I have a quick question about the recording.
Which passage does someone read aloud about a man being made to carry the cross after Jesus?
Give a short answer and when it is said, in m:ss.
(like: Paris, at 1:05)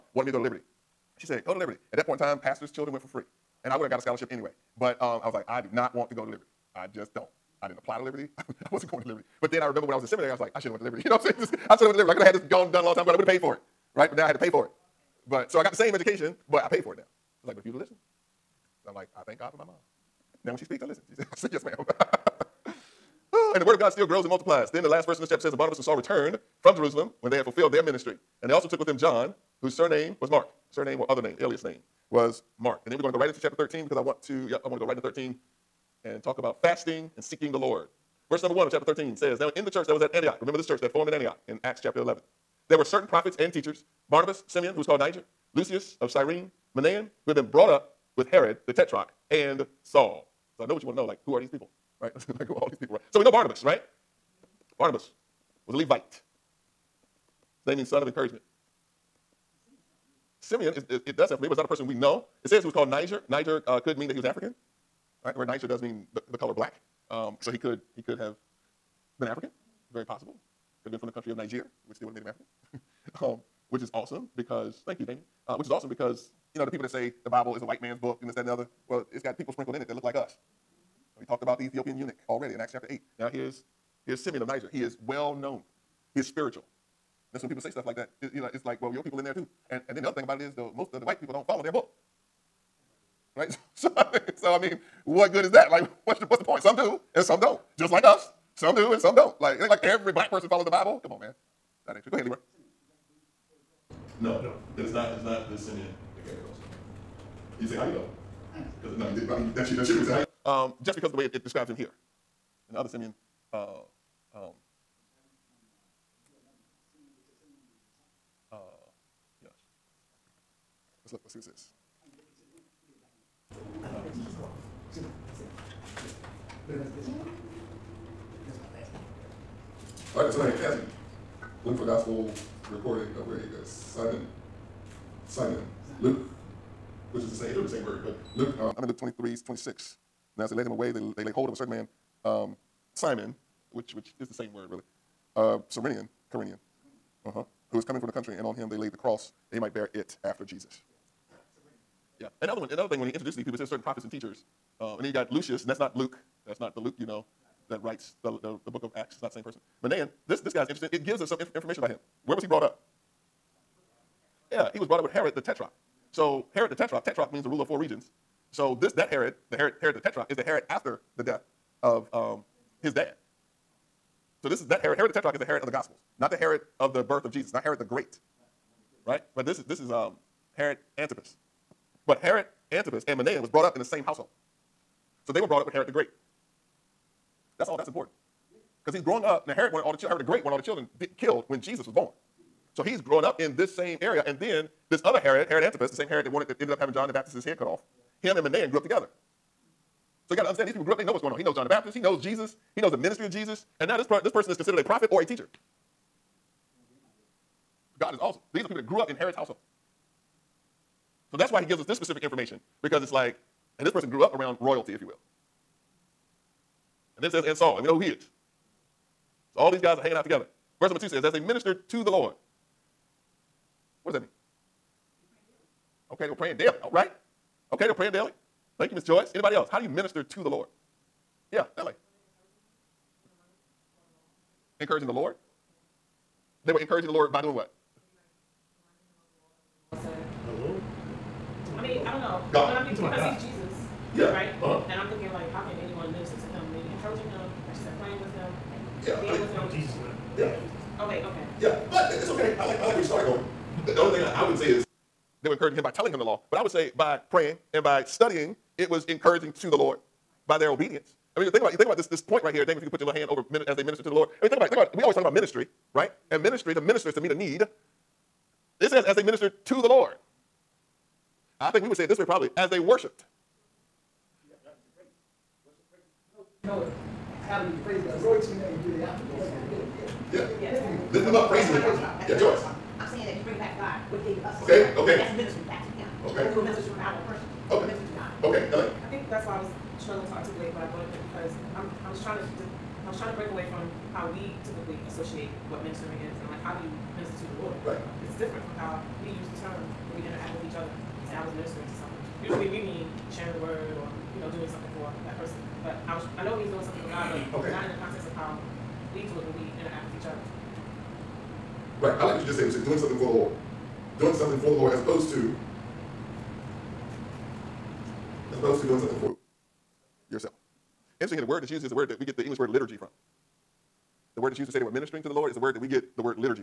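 Luke 23:26, at 2:18.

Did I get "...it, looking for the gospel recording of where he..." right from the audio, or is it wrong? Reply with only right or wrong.
right.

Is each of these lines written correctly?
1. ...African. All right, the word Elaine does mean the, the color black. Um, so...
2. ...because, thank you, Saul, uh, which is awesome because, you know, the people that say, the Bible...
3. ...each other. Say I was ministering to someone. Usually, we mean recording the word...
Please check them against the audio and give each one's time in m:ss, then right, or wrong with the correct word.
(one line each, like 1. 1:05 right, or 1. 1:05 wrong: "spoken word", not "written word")
1. 1:04 wrong: "Niger", not "Elaine"
2. 1:14 wrong: "Damien", not "Saul"
3. 5:00 wrong: "sharing", not "recording".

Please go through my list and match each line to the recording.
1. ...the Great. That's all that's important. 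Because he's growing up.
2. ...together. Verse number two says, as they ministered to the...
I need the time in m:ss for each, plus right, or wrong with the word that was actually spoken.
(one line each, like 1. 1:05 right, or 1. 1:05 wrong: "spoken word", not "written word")
1. 3:05 right
2. 3:40 right.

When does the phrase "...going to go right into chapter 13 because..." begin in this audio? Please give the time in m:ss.
0:33.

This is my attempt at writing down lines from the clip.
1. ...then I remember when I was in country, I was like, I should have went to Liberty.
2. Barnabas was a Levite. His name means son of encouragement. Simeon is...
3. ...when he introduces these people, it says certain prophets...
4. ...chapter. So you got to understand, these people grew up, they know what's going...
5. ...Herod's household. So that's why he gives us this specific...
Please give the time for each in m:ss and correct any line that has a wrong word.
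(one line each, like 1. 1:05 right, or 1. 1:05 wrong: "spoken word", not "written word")
1. 0:09 wrong: "seminary", not "country"
2. 0:54 right
3. 2:33 right
4. 3:18 wrong: "together", not "chapter"
5. 3:29 right.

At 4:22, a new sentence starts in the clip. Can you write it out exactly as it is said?
If you could put your little hand over as they minister to the Lord.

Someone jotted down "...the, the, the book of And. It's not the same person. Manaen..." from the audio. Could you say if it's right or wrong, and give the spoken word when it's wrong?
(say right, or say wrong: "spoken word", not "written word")
wrong: "Acts", not "And".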